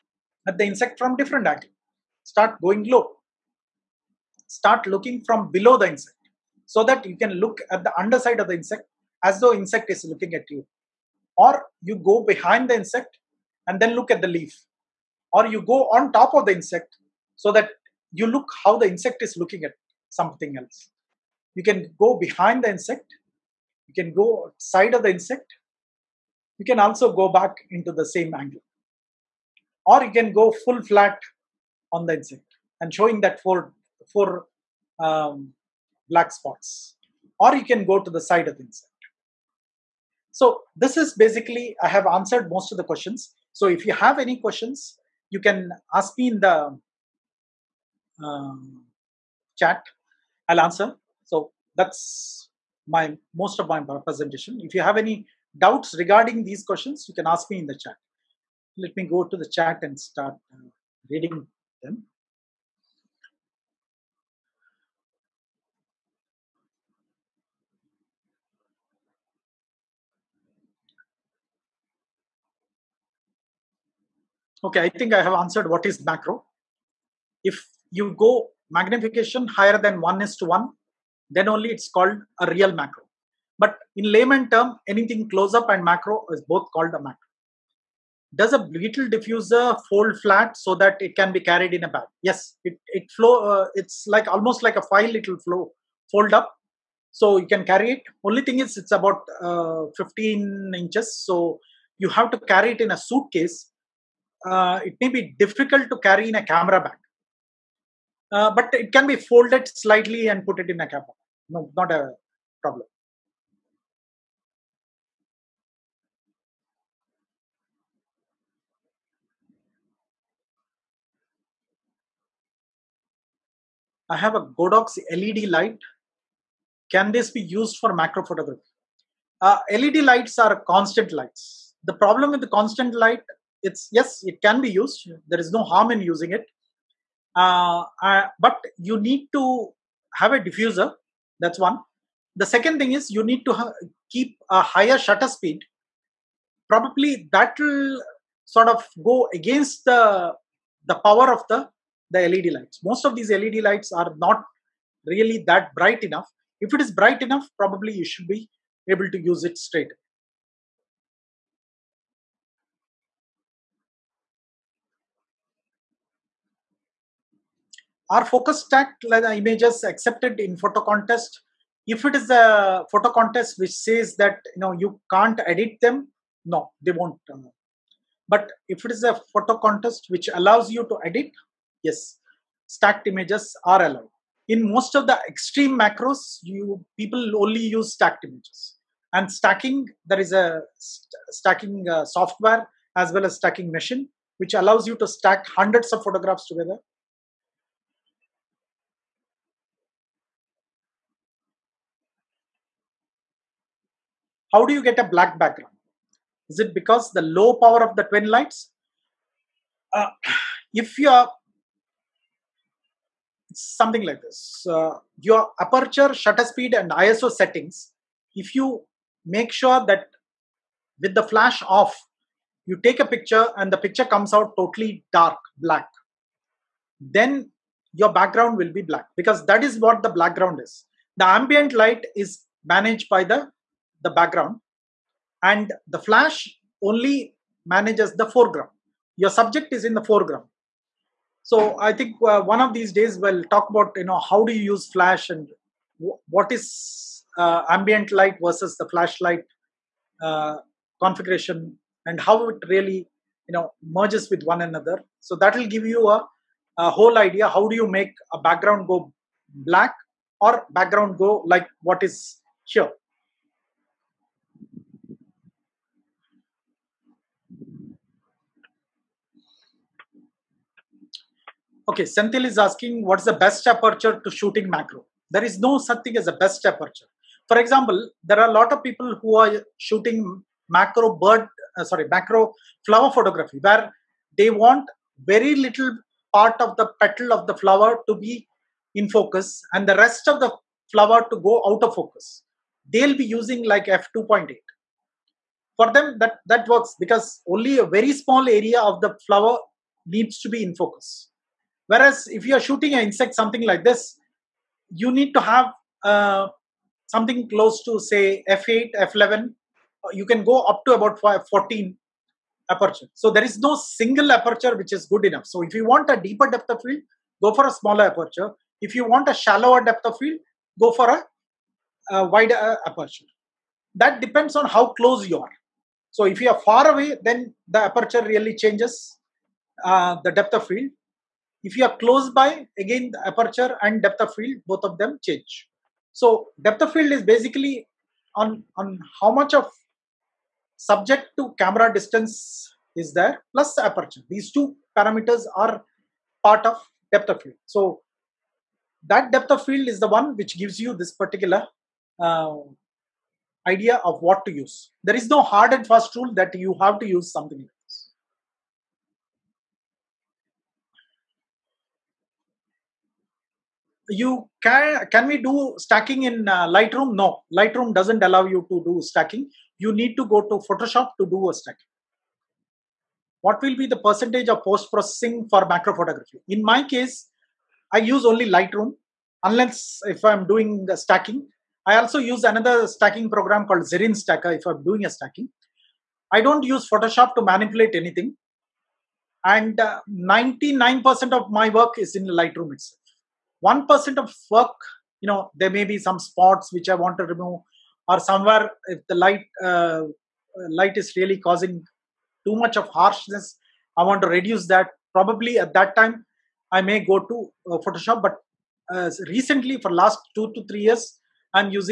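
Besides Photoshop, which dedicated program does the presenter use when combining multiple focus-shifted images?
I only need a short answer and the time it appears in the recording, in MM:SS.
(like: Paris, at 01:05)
Zerene Stacker, at 06:23.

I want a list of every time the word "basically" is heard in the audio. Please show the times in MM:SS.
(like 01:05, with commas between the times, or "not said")
00:41, 05:37.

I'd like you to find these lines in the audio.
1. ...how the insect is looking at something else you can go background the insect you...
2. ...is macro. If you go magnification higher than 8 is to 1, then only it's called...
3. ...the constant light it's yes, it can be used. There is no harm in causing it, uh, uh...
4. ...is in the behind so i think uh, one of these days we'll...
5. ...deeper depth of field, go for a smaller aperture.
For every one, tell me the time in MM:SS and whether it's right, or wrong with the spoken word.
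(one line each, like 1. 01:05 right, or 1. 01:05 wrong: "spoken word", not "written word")
1. 00:18 wrong: "behind", not "background"
2. 01:15 wrong: "1", not "8"
3. 02:12 wrong: "using", not "causing"
4. 03:59 wrong: "foreground", not "behind"
5. 05:16 right.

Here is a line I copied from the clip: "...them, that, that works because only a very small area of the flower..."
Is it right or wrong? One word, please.
right.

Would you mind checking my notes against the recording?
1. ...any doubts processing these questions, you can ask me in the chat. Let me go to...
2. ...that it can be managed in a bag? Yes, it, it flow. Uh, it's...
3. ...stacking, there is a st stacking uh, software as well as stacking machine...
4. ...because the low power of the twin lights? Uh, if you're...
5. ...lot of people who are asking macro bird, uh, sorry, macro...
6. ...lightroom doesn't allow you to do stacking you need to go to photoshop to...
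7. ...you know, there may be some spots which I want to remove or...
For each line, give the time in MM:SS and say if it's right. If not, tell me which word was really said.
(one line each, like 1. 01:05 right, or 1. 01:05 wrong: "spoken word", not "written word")
1. 00:54 wrong: "regarding", not "processing"
2. 01:30 wrong: "carried", not "managed"
3. 03:09 right
4. 03:26 right
5. 04:38 wrong: "shooting", not "asking"
6. 06:07 right
7. 06:35 right.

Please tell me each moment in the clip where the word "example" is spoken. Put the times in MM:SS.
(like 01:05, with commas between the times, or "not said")
04:37.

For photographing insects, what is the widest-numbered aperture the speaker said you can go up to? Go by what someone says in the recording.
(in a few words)
14.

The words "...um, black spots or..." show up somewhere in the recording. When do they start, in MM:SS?
00:35.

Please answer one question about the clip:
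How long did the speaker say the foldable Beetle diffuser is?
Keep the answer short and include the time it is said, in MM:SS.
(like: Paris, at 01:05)
15 inches, at 01:39.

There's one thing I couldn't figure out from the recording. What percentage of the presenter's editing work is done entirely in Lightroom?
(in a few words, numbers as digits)
99%.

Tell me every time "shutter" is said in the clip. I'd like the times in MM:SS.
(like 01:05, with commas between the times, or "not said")
02:24, 03:36.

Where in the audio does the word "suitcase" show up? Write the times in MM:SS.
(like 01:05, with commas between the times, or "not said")
01:42.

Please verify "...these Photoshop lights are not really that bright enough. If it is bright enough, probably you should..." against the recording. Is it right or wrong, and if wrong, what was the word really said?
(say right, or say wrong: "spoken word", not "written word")
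wrong: "LED", not "Photoshop".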